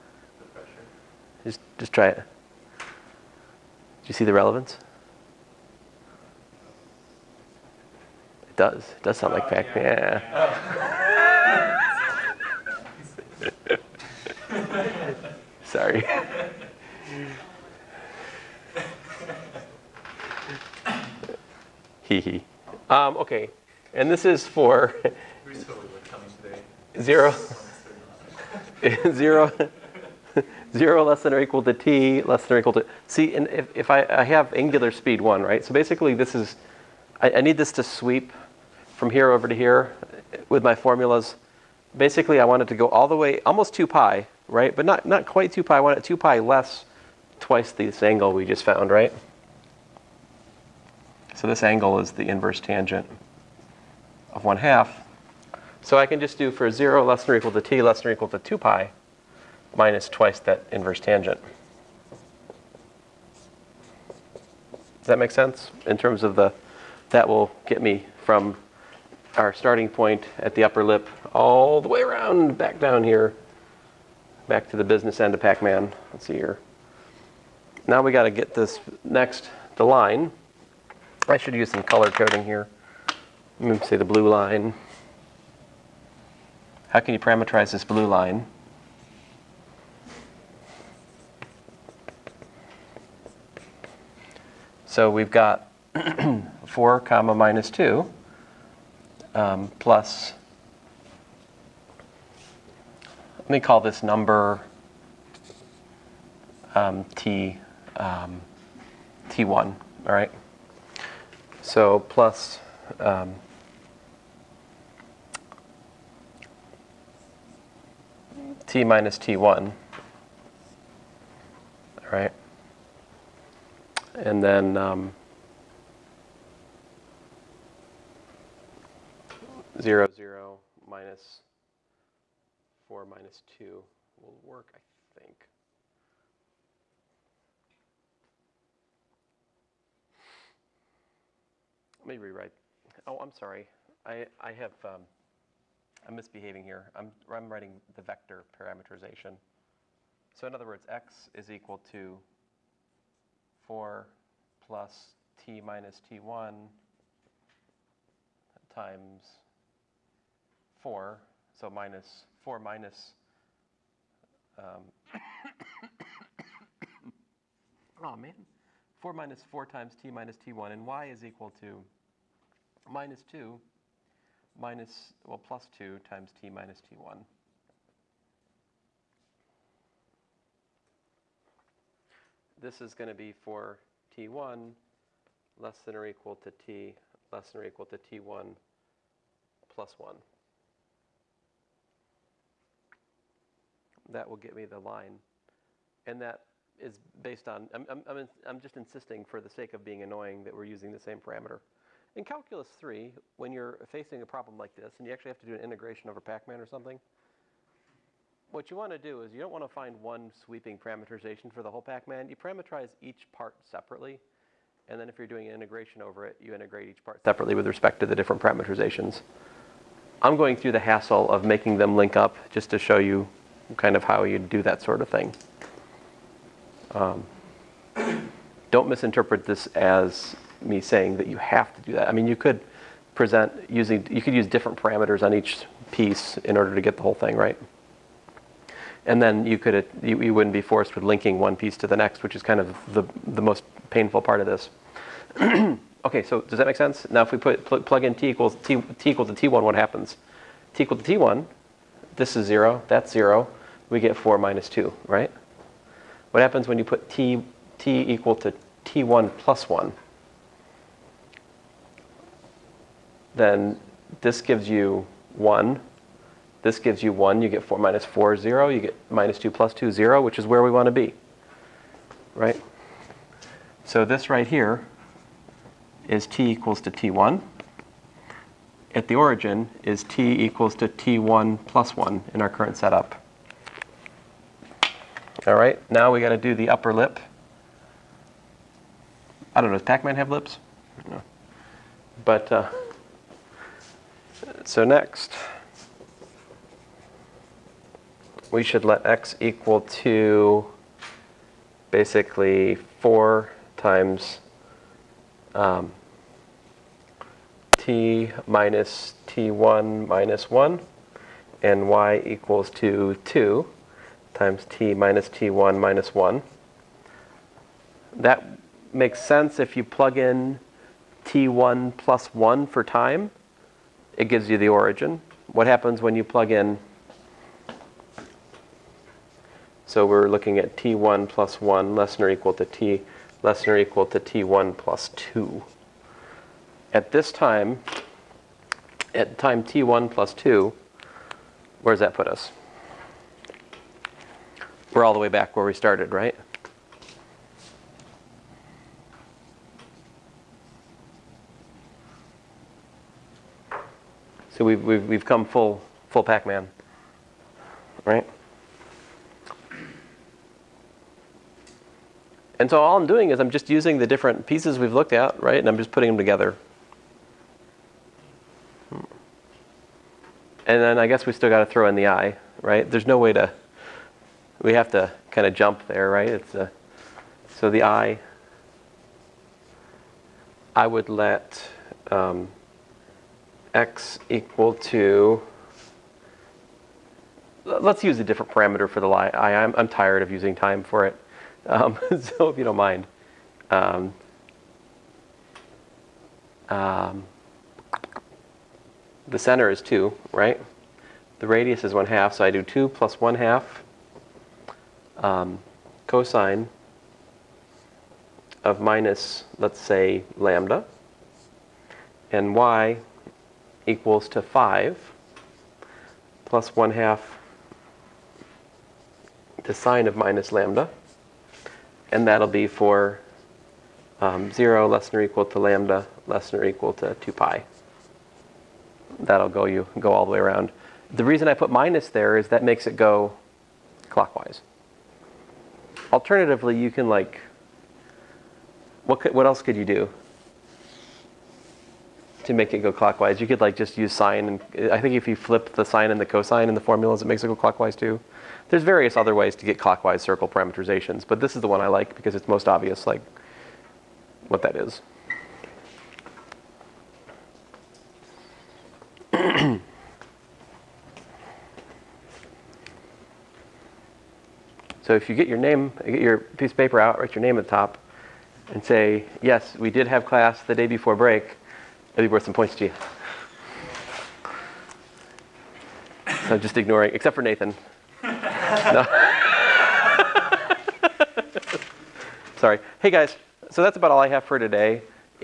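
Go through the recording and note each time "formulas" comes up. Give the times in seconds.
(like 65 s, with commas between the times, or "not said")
40 s, 446 s.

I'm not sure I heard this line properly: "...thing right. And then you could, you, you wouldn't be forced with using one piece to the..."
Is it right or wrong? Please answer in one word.
wrong.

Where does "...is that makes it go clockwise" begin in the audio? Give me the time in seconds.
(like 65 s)
432 s.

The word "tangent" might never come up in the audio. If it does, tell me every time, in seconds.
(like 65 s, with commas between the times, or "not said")
52 s, 60 s.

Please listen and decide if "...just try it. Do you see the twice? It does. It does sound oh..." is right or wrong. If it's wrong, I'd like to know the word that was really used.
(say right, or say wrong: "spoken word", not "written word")
wrong: "relevance", not "twice".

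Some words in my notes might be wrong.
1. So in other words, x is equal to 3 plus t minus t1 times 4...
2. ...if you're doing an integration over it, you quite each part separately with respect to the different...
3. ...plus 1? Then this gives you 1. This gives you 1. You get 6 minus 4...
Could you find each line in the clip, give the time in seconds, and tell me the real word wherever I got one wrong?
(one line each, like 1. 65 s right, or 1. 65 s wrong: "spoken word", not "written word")
1. 150 s wrong: "4", not "3"
2. 215 s wrong: "integrate", not "quite"
3. 259 s wrong: "4", not "6".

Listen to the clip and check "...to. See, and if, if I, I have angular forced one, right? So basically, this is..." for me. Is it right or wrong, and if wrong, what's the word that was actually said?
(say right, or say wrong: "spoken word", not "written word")
wrong: "speed", not "forced".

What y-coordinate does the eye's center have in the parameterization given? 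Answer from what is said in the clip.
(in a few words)
5.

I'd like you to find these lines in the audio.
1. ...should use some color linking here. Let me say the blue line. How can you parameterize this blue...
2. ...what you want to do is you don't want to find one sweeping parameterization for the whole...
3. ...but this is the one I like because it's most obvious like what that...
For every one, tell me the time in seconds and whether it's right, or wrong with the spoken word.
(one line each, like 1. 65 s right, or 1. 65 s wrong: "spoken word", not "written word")
1. 81 s wrong: "coding", not "linking"
2. 208 s right
3. 451 s right.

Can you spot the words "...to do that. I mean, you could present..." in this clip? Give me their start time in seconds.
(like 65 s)
231 s.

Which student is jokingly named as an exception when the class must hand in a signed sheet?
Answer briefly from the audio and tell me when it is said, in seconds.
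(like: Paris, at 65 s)
Nathan, at 477 s.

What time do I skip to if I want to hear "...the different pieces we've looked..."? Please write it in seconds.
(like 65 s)
363 s.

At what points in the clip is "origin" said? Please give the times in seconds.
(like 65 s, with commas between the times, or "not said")
279 s, 324 s.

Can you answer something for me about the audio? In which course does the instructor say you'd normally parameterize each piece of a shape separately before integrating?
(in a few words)
Calculus 3.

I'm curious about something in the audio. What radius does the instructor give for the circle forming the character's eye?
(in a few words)
1/2.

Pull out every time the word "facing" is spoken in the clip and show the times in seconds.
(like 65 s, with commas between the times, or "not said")
203 s.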